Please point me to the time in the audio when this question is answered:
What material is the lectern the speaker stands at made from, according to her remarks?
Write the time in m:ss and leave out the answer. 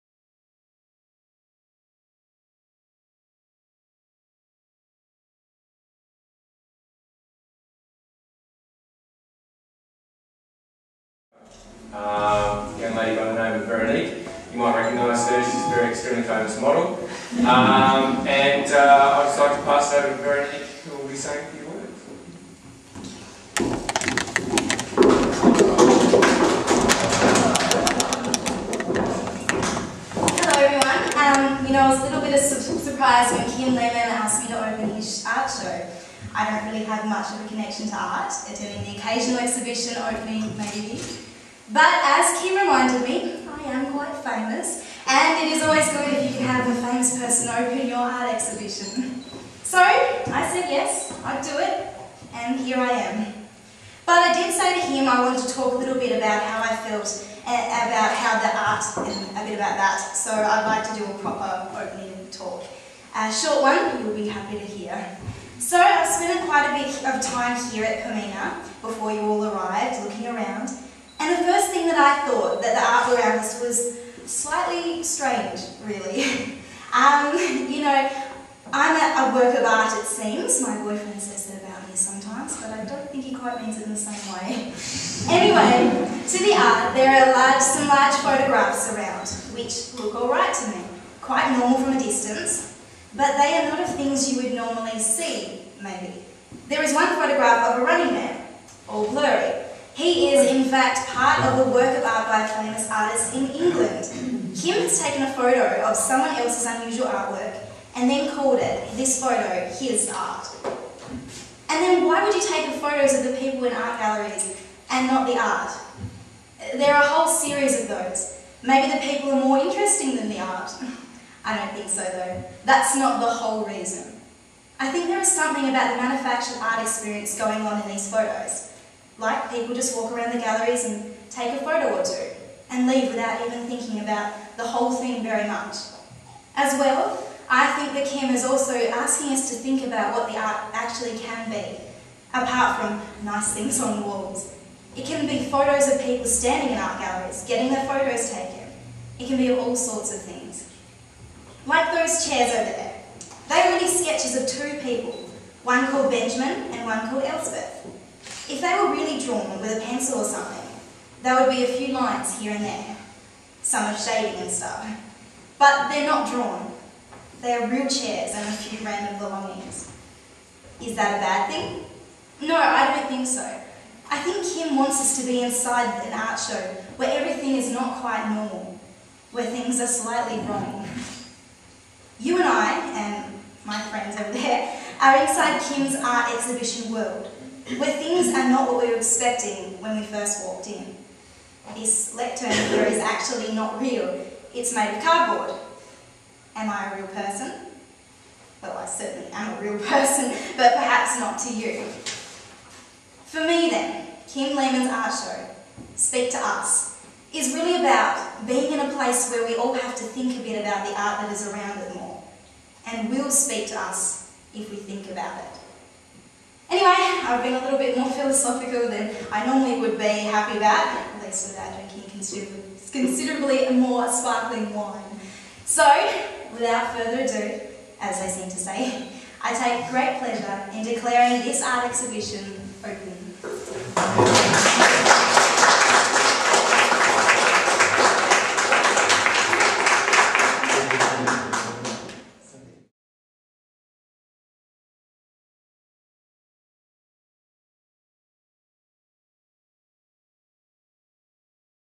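3:15.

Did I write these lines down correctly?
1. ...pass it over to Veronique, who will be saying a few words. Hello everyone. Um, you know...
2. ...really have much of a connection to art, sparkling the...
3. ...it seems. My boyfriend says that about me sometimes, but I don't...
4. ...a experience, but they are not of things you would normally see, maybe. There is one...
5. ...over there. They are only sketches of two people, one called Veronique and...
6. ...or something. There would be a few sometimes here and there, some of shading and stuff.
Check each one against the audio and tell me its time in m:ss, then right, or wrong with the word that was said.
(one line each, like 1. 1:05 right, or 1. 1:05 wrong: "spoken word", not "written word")
1. 0:19 right
2. 0:36 wrong: "attending", not "sparkling"
3. 1:19 right
4. 1:31 wrong: "distance", not "experience"
5. 2:32 wrong: "Benjamin", not "Veronique"
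6. 2:40 wrong: "lines", not "sometimes".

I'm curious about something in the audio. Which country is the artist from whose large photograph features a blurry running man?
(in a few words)
England.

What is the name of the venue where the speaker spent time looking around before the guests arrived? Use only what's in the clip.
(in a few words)
Poimena.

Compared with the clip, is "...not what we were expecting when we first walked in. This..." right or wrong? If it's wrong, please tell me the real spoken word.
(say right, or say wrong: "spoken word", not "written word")
right.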